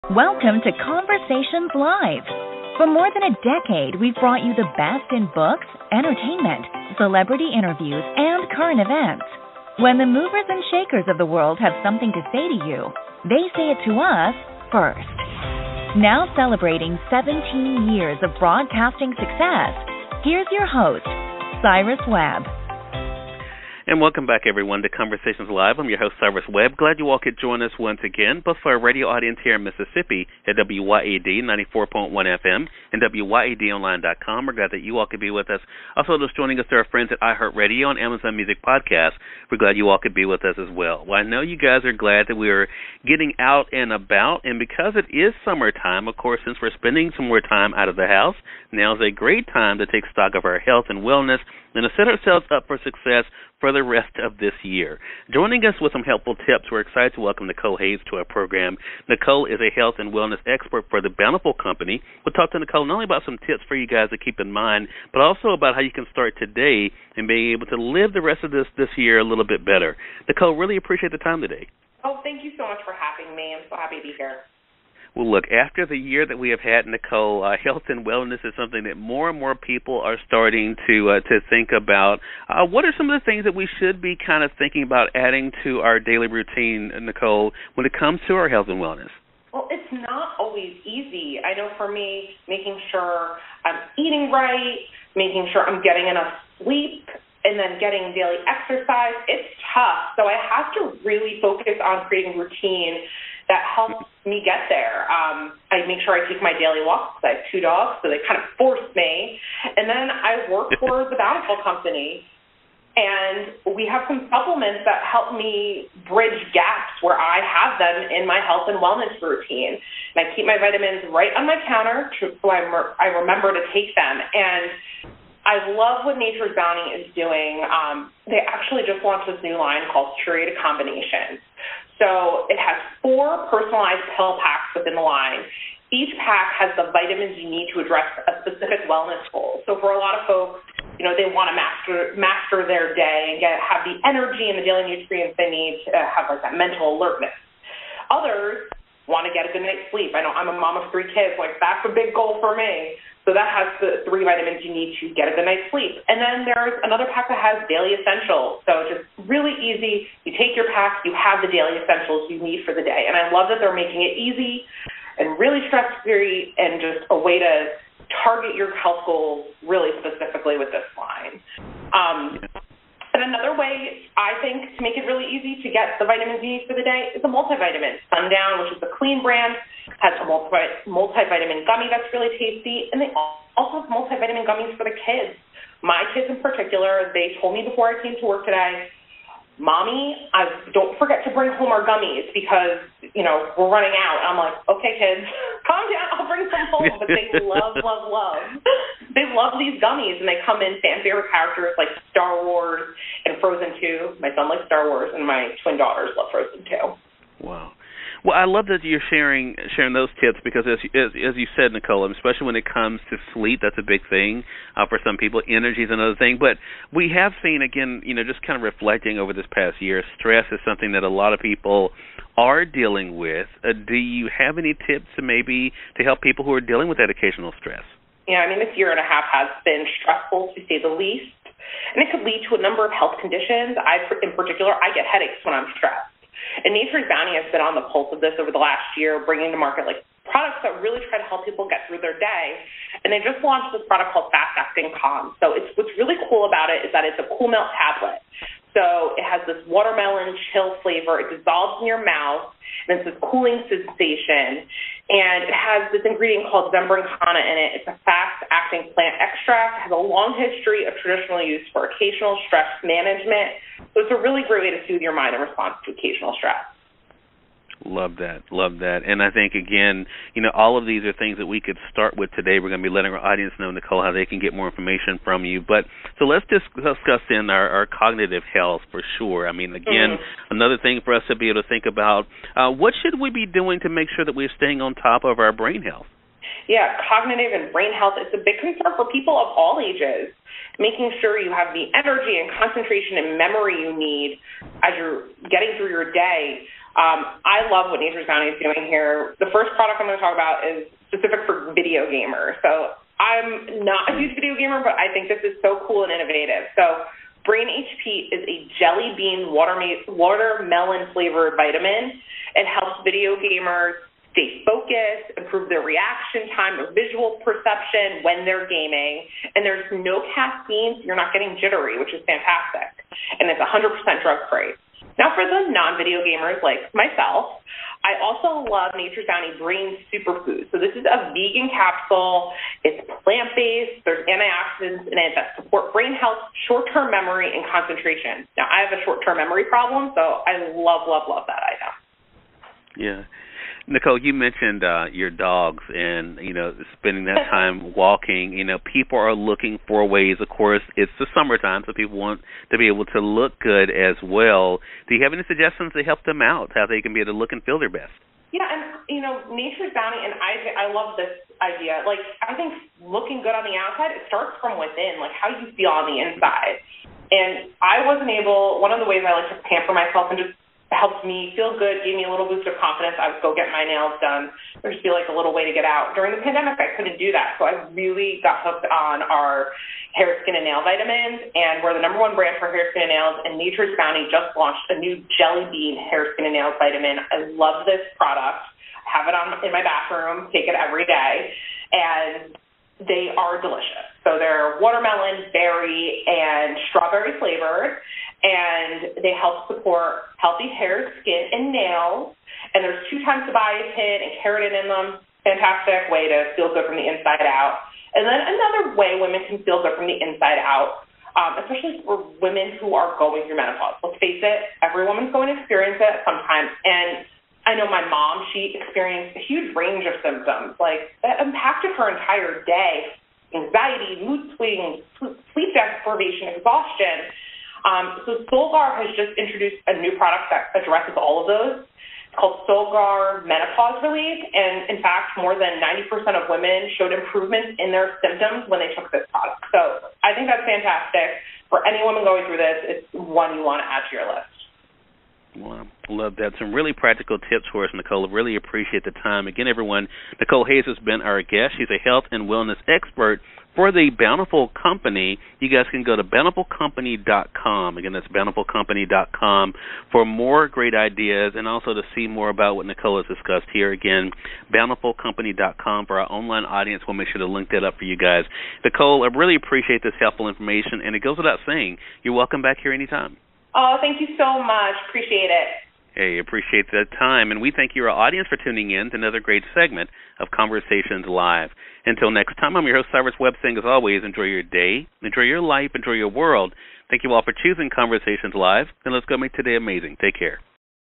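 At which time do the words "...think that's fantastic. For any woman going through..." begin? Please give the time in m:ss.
7:20.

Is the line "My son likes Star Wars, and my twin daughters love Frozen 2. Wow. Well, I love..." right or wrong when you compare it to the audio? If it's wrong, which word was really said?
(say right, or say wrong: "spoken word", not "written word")
right.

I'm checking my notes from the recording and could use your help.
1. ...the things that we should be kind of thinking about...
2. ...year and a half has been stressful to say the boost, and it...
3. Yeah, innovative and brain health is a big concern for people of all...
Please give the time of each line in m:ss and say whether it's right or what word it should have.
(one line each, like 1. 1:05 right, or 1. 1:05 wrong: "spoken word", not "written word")
1. 1:23 right
2. 3:48 wrong: "least", not "boost"
3. 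4:46 wrong: "cognitive", not "innovative".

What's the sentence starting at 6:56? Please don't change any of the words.
And I know my mom, she experienced a huge range of symptoms.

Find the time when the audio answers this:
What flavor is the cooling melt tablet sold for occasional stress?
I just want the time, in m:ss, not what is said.
4:09.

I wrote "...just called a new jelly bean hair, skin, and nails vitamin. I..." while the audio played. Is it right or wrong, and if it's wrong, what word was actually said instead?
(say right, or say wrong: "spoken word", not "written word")
wrong: "launched", not "called".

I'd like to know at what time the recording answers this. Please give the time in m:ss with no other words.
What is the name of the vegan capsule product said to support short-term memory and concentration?
5:29.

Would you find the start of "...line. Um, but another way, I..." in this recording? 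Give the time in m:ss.
2:50.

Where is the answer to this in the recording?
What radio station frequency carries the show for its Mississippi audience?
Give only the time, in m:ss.
0:31.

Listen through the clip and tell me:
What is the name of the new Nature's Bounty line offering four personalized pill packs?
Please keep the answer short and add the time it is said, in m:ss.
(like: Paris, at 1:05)
Curated Combinations, at 2:10.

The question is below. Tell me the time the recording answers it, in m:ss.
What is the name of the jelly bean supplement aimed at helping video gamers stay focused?
5:07.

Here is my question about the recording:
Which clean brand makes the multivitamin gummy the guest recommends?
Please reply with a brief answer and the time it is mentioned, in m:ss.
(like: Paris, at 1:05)
Sundown, at 2:58.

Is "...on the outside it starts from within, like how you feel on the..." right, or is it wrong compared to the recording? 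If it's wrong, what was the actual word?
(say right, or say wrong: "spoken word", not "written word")
right.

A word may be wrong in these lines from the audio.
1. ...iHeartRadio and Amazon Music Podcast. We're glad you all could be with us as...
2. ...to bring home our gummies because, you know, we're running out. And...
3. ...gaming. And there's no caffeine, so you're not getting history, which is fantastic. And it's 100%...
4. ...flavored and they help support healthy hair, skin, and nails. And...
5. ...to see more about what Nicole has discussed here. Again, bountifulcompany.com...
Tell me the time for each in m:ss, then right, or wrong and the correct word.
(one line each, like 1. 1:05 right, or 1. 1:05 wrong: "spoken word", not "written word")
1. 0:37 right
2. 3:11 right
3. 5:18 wrong: "jittery", not "history"
4. 6:37 right
5. 7:41 right.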